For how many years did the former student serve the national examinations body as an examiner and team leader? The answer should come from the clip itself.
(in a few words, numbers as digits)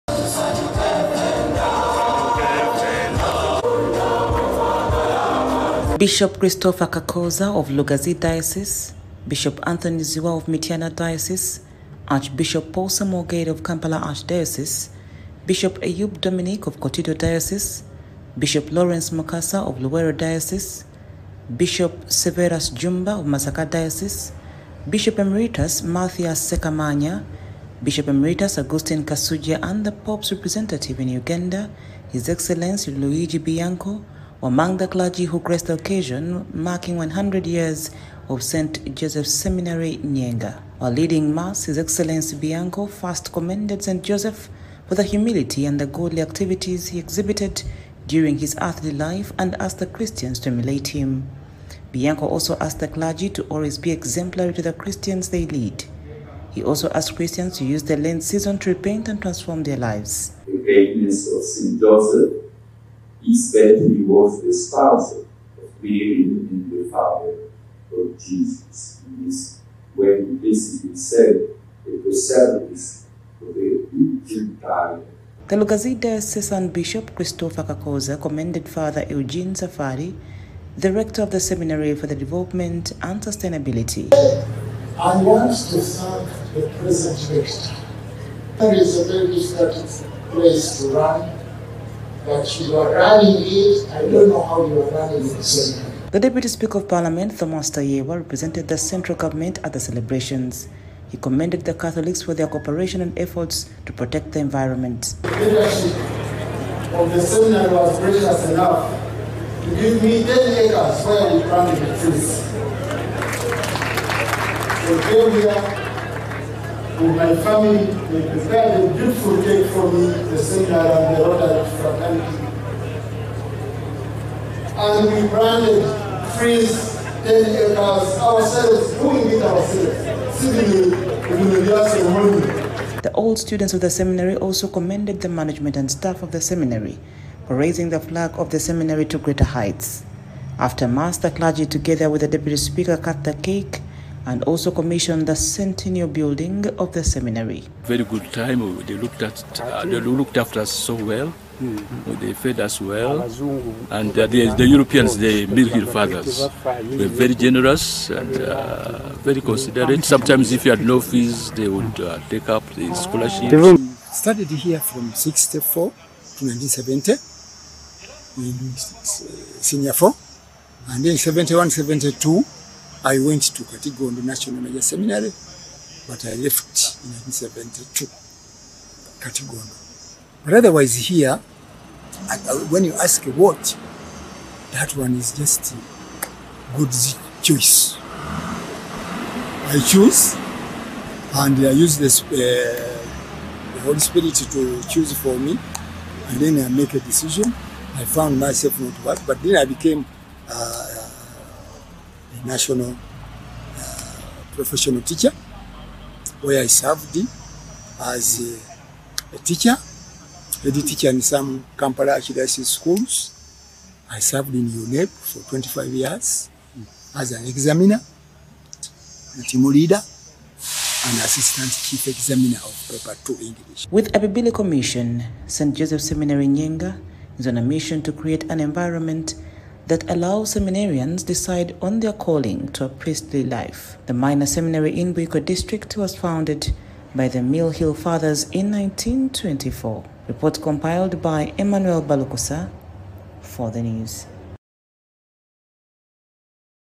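25 years.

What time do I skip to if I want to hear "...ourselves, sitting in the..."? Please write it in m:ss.
2:09.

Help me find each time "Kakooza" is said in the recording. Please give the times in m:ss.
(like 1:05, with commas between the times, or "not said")
0:06, 1:17.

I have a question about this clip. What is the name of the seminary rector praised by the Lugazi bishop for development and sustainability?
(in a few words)
Father Eugene Safari.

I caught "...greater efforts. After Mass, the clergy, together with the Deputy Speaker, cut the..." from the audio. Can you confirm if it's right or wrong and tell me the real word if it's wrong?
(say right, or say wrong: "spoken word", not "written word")
wrong: "heights", not "efforts".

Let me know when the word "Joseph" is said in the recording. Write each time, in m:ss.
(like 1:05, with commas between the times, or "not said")
0:38, 0:44, 1:01, 3:45.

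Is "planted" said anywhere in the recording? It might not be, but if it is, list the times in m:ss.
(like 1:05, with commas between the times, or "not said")
1:51, 2:05.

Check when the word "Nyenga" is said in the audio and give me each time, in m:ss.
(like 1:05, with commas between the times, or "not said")
0:39, 3:46.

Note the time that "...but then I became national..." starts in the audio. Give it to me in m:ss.
3:19.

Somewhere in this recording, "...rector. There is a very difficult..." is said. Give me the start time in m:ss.
1:27.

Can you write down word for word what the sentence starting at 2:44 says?
Started here from '64 to 1970 in uh, senior four, and then '71, '72.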